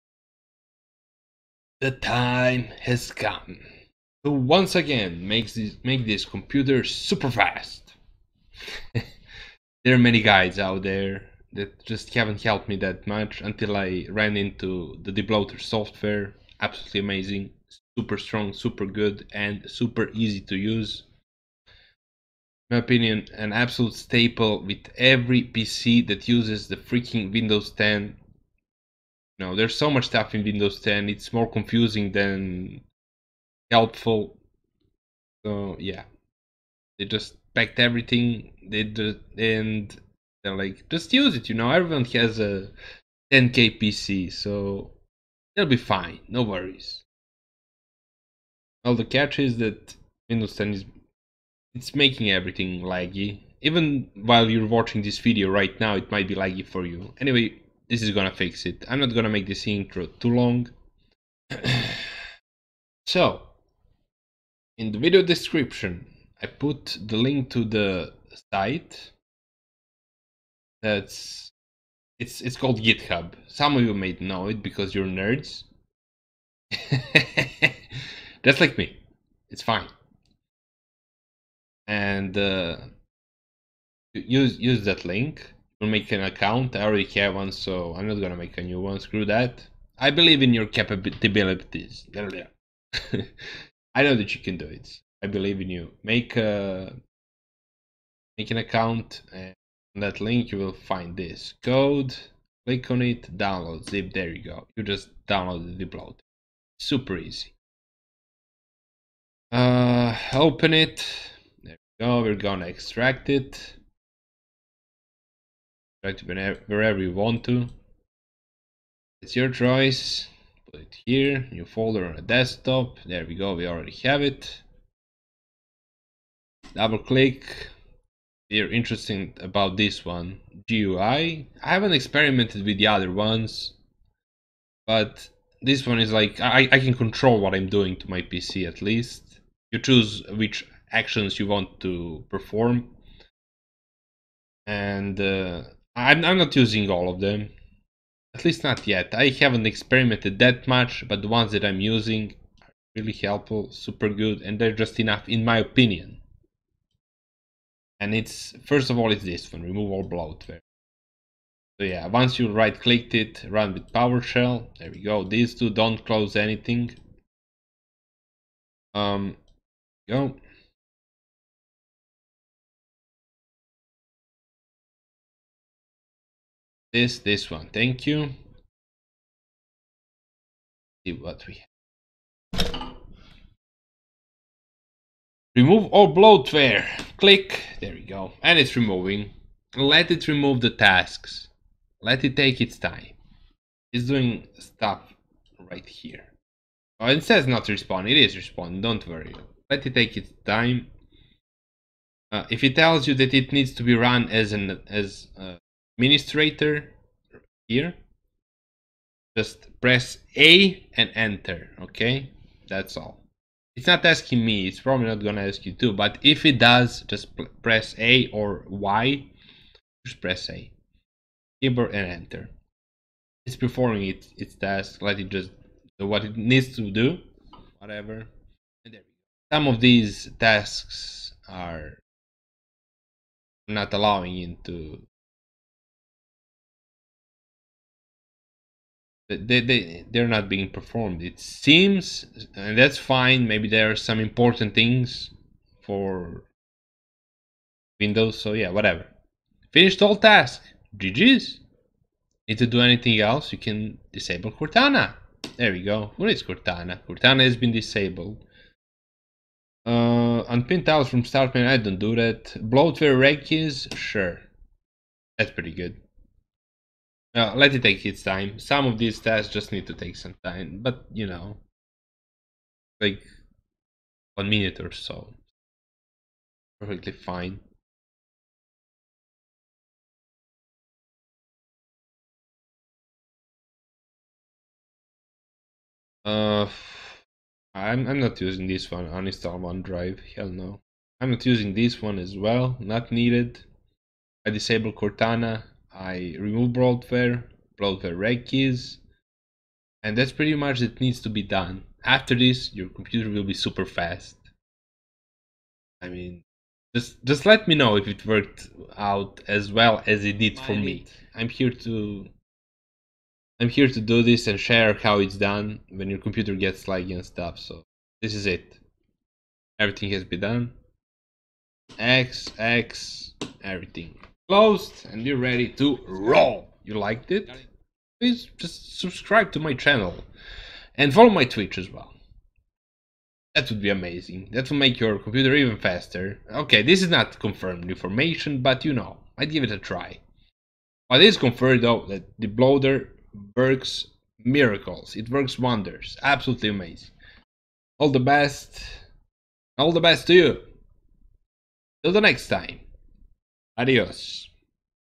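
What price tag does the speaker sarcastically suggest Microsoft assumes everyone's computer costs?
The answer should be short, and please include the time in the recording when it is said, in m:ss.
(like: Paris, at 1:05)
10k, at 0:43.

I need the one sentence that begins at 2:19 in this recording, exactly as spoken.
You choose which actions you want to perform and uh, I'm, I'm not using all of them.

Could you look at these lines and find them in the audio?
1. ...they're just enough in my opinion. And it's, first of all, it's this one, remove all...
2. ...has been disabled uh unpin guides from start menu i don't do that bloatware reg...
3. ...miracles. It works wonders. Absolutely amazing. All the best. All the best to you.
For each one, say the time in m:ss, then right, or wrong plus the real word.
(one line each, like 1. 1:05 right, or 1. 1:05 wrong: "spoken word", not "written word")
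1. 2:34 right
2. 4:17 wrong: "tiles", not "guides"
3. 5:44 right.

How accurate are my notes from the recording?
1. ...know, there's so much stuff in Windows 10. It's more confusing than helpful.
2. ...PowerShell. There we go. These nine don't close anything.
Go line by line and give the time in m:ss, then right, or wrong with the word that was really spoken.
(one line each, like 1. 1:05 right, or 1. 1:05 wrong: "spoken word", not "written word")
1. 0:29 right
2. 2:43 wrong: "two", not "nine".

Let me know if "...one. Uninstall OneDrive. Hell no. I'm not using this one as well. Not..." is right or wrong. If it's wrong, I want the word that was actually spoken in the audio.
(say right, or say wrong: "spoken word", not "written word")
right.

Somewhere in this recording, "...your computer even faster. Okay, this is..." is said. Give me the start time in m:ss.
5:34.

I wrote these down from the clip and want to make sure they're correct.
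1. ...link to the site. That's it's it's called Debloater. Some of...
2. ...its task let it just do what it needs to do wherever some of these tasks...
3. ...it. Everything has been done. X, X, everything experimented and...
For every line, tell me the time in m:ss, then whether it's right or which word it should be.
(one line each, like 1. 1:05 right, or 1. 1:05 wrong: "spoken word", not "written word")
1. 1:07 wrong: "GitHub", not "Debloater"
2. 3:44 wrong: "whatever", not "wherever"
3. 5:18 wrong: "closed", not "experimented".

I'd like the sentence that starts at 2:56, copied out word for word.
this this one thank you see what we have.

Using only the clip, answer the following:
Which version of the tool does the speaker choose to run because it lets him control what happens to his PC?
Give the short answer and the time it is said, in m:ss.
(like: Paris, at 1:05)
GUI, at 2:10.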